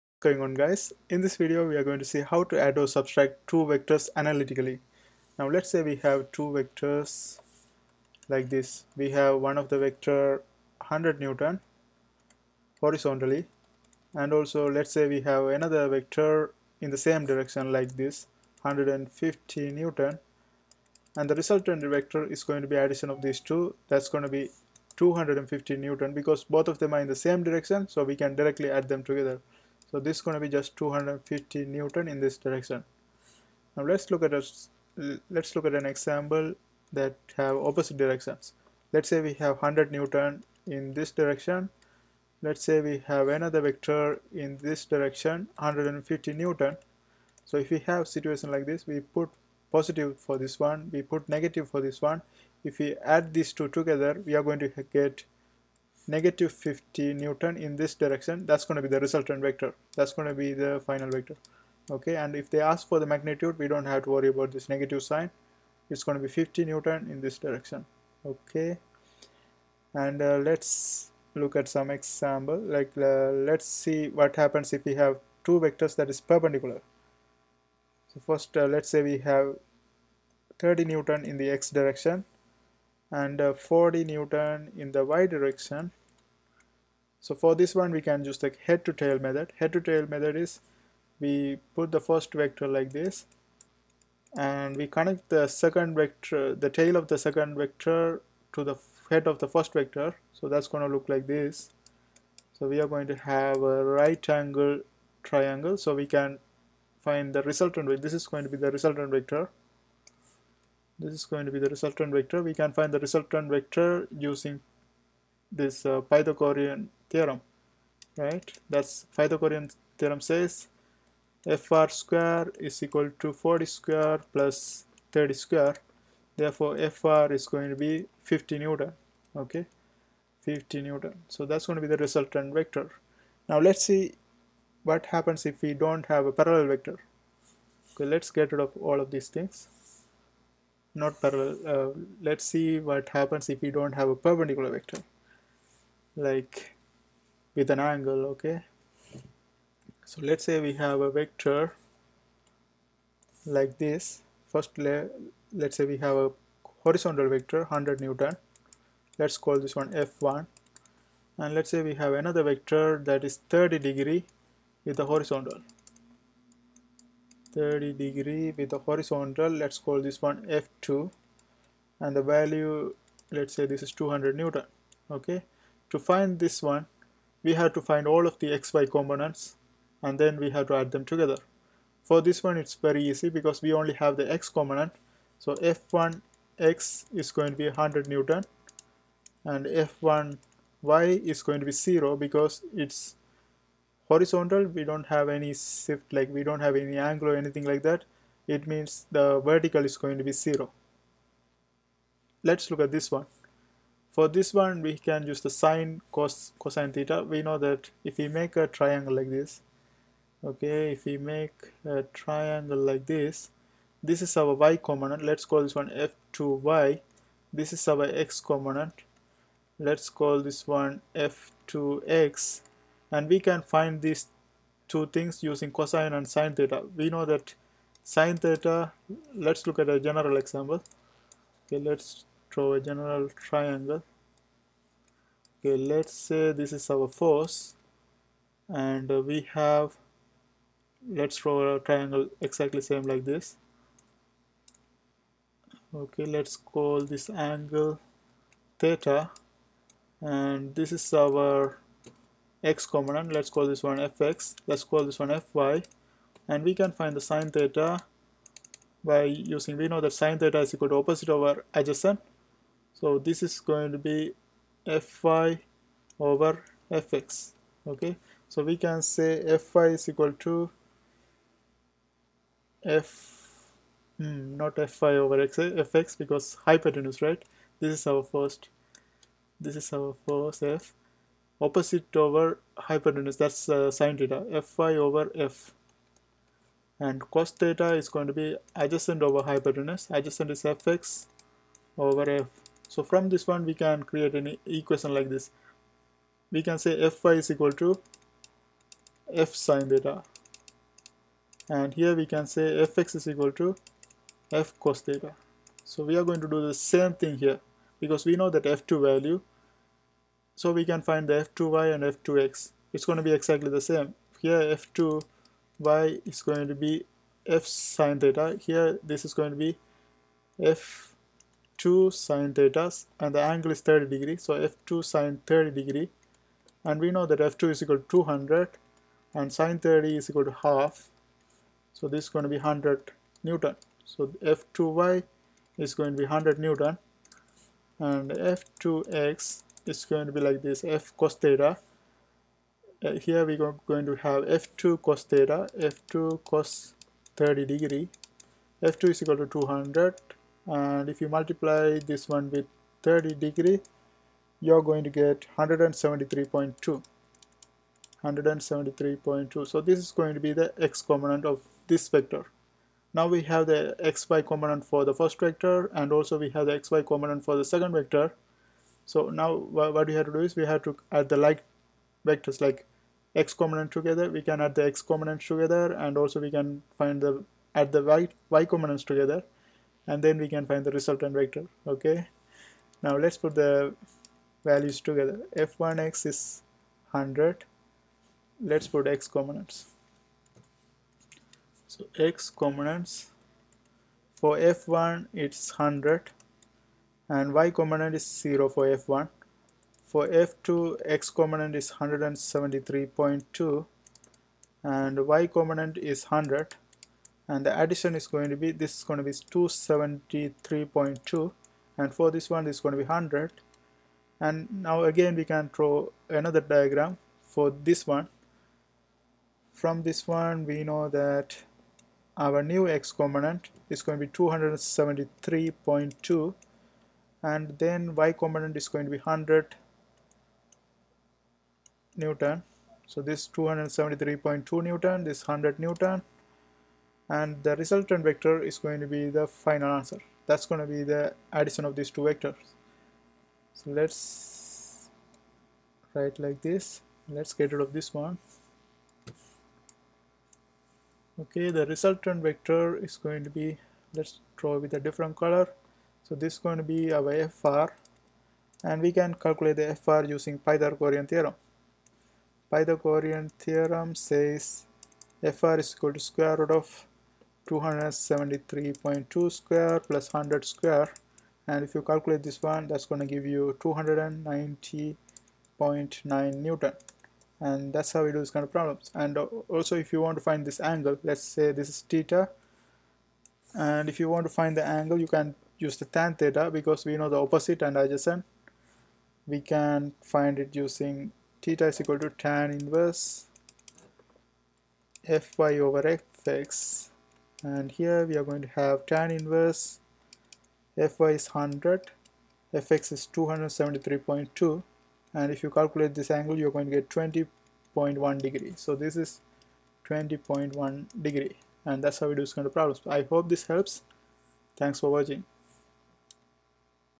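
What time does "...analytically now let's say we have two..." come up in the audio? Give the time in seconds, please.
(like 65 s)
4 s.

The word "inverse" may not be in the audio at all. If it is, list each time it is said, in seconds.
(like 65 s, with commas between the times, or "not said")
492 s, 499 s.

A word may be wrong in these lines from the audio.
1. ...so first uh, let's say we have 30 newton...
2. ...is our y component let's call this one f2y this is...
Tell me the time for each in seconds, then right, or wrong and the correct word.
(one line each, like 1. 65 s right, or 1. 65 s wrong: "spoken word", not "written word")
1. 78 s right
2. 214 s right.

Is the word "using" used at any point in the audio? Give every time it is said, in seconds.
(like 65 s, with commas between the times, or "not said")
114 s, 225 s, 259 s, 460 s, 490 s.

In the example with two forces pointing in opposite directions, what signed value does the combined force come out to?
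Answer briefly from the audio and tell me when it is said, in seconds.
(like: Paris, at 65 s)
-50 newton, at 56 s.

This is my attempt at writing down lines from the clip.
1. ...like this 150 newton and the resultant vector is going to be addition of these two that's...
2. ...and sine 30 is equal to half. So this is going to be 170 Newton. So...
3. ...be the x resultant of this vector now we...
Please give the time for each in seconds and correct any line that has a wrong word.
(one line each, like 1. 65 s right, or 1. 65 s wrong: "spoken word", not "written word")
1. 17 s right
2. 329 s wrong: "100", not "170"
3. 360 s wrong: "component", not "resultant".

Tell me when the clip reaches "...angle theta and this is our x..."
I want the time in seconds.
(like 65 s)
247 s.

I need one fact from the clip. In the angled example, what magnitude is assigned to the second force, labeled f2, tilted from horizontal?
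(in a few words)
200 newton.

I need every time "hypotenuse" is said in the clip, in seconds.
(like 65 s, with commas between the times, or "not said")
276 s, 282 s, 289 s.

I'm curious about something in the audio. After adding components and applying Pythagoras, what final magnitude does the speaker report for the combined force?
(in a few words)
290.9 newton.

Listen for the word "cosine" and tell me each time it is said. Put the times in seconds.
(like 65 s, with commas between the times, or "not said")
206 s, 225 s.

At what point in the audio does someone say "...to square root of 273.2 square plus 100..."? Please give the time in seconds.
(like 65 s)
466 s.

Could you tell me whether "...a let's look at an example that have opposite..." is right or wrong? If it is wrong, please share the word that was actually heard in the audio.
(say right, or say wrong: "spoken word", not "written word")
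right.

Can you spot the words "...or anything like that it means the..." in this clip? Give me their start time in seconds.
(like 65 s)
197 s.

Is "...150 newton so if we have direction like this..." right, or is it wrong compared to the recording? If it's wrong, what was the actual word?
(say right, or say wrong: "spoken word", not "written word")
wrong: "situation", not "direction".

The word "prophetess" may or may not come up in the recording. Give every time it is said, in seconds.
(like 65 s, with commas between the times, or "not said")
not said.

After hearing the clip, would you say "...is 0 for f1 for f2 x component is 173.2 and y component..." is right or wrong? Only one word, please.
right.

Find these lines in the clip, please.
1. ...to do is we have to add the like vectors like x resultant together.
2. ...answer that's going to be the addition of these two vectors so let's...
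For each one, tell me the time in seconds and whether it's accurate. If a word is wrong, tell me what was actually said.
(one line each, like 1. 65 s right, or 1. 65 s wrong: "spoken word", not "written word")
1. 370 s wrong: "component", not "resultant"
2. 439 s right.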